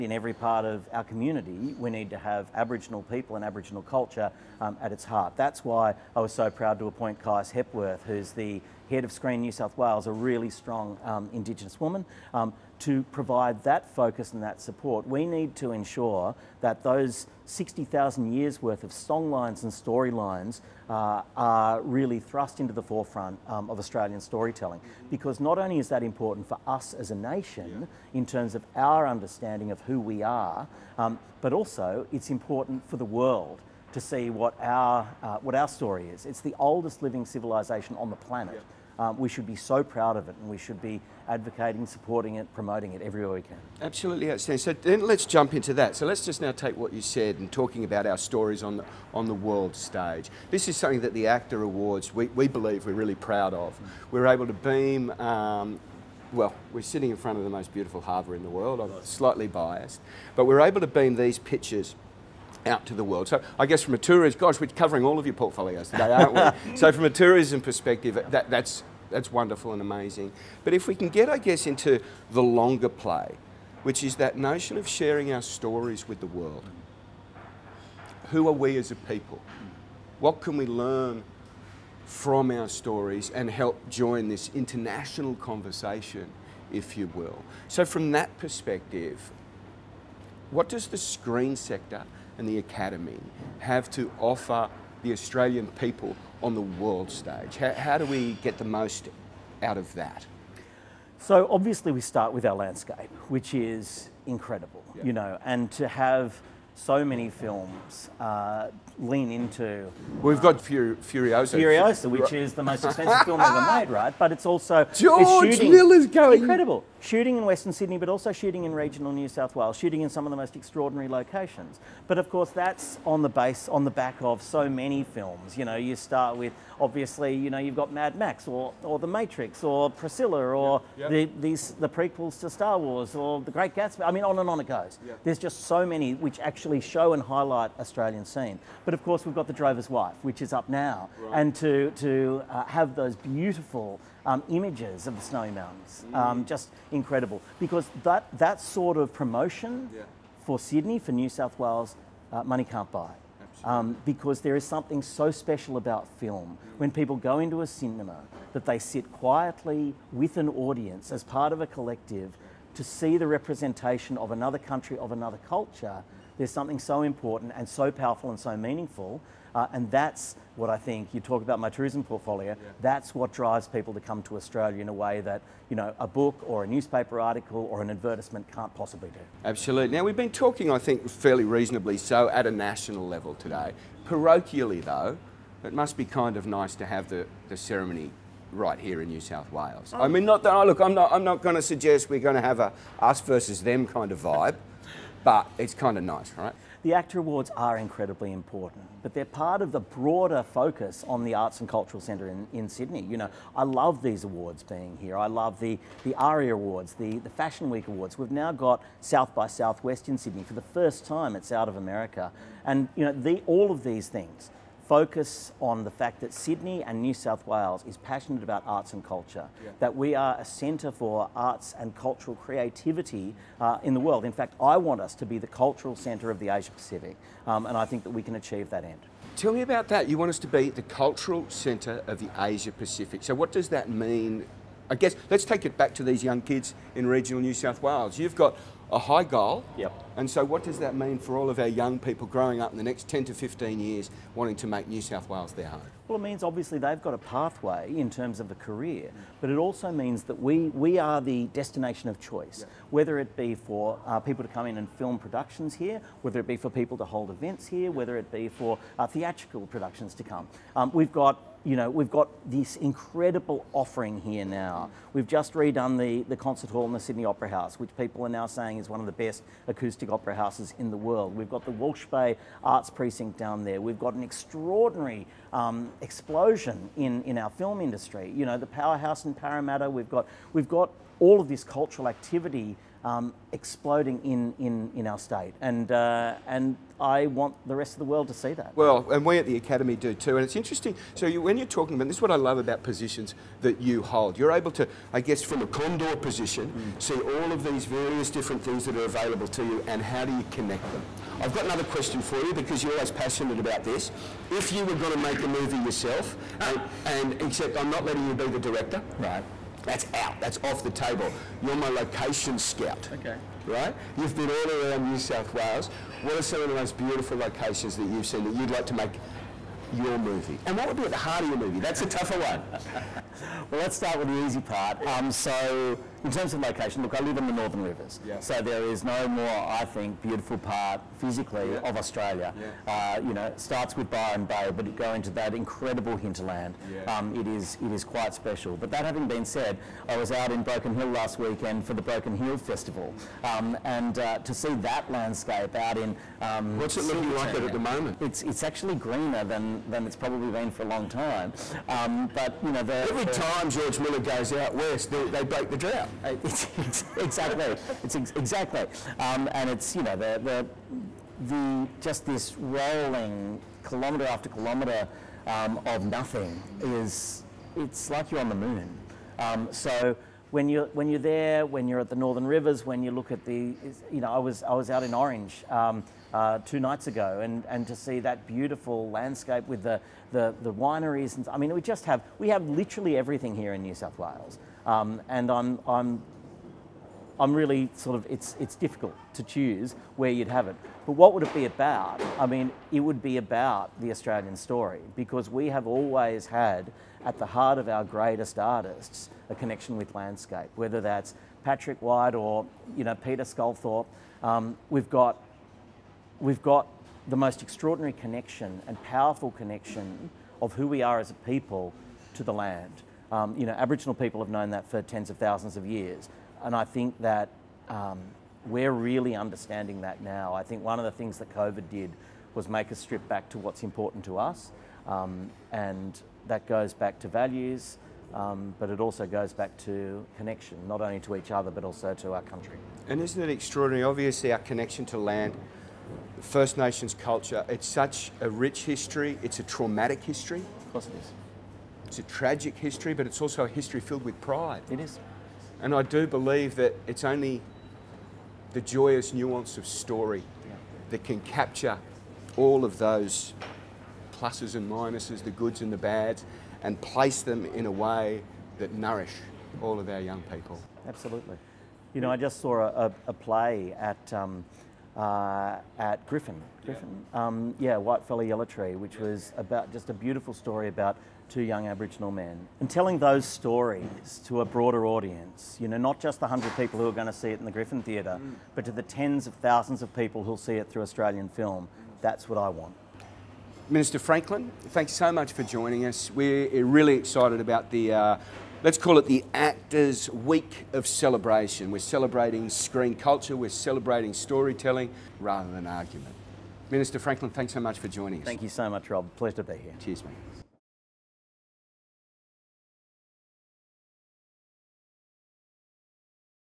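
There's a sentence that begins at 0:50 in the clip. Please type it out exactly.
This is something that the AACTA Awards, we, we believe we're really proud of.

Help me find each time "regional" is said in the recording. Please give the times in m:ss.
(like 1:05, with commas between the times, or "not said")
1:58, 3:57.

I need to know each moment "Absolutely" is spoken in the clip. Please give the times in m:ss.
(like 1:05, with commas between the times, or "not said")
0:43, 2:59, 7:41.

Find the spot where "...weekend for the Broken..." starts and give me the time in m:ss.
5:41.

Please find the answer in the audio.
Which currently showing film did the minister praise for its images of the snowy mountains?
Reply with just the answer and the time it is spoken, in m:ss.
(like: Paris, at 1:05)
The Drover's Wife, at 2:19.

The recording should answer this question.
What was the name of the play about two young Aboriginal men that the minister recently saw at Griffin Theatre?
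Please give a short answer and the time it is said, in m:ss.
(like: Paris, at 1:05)
Whitefella Yella Tree, at 7:47.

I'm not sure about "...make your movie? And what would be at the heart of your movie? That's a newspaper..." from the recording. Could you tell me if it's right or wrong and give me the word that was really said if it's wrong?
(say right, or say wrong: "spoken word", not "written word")
wrong: "tougher", not "newspaper".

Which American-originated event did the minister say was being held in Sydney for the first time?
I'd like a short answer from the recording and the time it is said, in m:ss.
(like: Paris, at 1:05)
South by Southwest, at 3:28.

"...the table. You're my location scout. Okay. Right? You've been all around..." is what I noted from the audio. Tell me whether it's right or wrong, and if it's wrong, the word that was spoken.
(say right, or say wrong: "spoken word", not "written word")
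right.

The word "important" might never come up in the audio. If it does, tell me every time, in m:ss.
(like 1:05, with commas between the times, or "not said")
0:26, 0:32, 2:47, 3:18, 7:03.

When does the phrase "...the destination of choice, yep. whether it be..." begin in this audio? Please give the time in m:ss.
4:11.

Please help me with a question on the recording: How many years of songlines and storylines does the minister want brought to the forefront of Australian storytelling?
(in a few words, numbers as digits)
60,000.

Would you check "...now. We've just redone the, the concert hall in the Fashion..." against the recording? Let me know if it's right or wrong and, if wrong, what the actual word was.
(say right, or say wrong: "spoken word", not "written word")
wrong: "Sydney", not "Fashion".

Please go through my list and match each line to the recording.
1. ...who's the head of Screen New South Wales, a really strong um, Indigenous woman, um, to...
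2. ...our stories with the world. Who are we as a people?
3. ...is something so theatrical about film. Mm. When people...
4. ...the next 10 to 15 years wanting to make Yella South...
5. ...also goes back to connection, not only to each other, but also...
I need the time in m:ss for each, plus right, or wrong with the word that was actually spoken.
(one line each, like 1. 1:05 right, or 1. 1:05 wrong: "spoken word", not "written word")
1. 0:08 right
2. 1:15 right
3. 2:34 wrong: "special", not "theatrical"
4. 4:02 wrong: "New", not "Yella"
5. 7:09 right.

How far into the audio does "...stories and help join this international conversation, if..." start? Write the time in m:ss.
1:22.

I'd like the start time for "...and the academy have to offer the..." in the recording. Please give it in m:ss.
1:32.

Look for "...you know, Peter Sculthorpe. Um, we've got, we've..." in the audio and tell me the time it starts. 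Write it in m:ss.
6:42.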